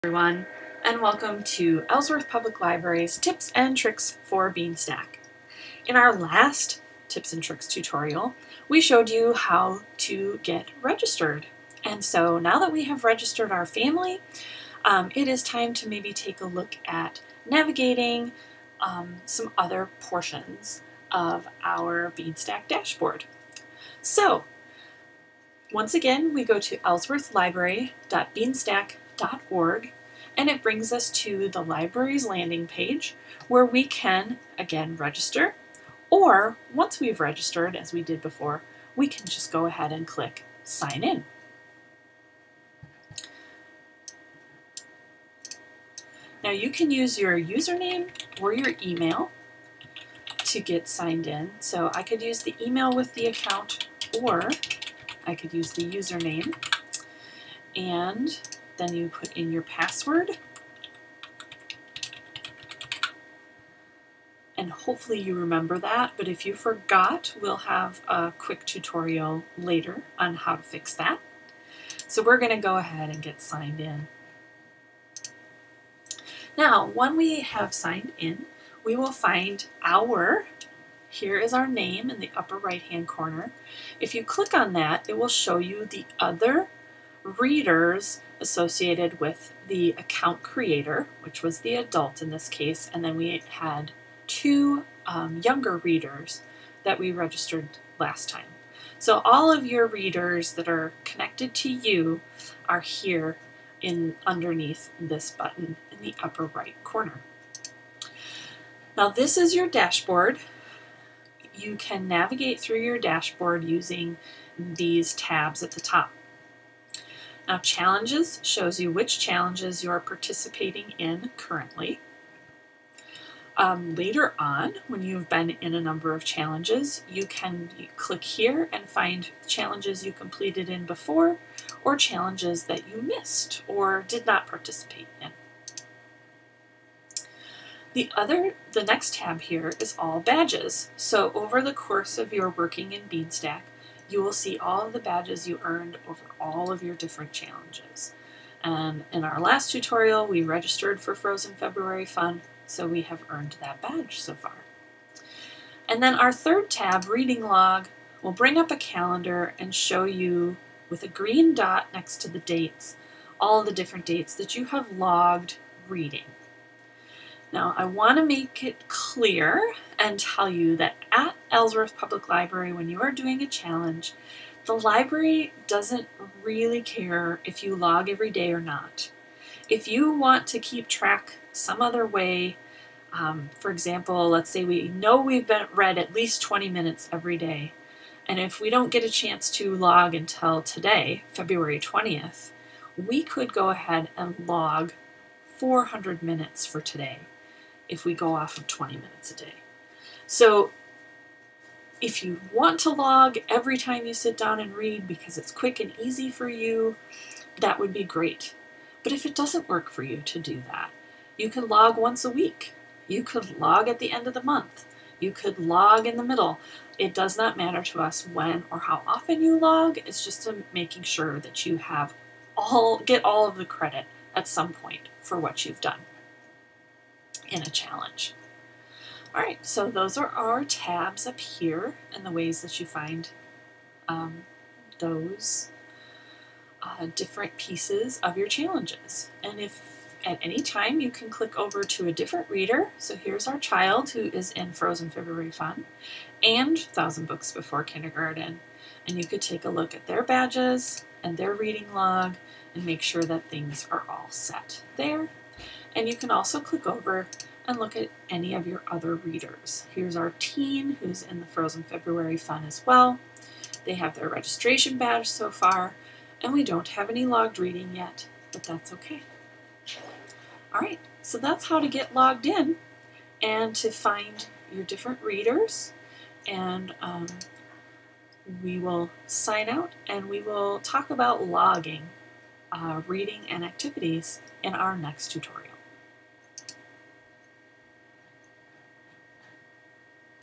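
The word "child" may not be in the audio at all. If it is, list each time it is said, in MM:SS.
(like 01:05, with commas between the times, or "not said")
04:03.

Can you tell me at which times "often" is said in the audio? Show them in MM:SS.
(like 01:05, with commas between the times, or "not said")
03:39.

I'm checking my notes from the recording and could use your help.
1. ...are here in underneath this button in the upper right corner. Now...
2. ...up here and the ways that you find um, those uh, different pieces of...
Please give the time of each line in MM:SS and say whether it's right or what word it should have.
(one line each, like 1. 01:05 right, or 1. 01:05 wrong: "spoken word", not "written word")
1. 01:42 right
2. 03:51 right.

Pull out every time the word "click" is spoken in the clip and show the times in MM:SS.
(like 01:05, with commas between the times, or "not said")
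00:40, 01:24, 02:07, 04:01, 04:16.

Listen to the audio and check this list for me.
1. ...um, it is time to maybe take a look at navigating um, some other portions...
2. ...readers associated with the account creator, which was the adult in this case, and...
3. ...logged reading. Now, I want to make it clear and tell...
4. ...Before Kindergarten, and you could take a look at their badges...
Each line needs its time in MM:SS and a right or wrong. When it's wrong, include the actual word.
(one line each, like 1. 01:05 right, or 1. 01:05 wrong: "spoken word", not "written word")
1. 00:14 right
2. 01:27 right
3. 02:44 right
4. 04:07 right.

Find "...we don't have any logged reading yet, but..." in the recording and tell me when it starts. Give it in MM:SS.
04:26.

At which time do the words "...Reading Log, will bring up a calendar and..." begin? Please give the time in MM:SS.
02:37.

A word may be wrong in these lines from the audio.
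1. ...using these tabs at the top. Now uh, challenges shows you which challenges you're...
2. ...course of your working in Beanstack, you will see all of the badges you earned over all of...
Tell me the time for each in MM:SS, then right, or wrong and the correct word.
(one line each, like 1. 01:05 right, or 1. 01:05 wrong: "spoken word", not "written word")
1. 01:53 right
2. 02:21 right.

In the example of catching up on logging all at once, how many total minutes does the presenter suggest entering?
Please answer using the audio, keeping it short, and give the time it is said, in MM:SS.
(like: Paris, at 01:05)
400, at 03:15.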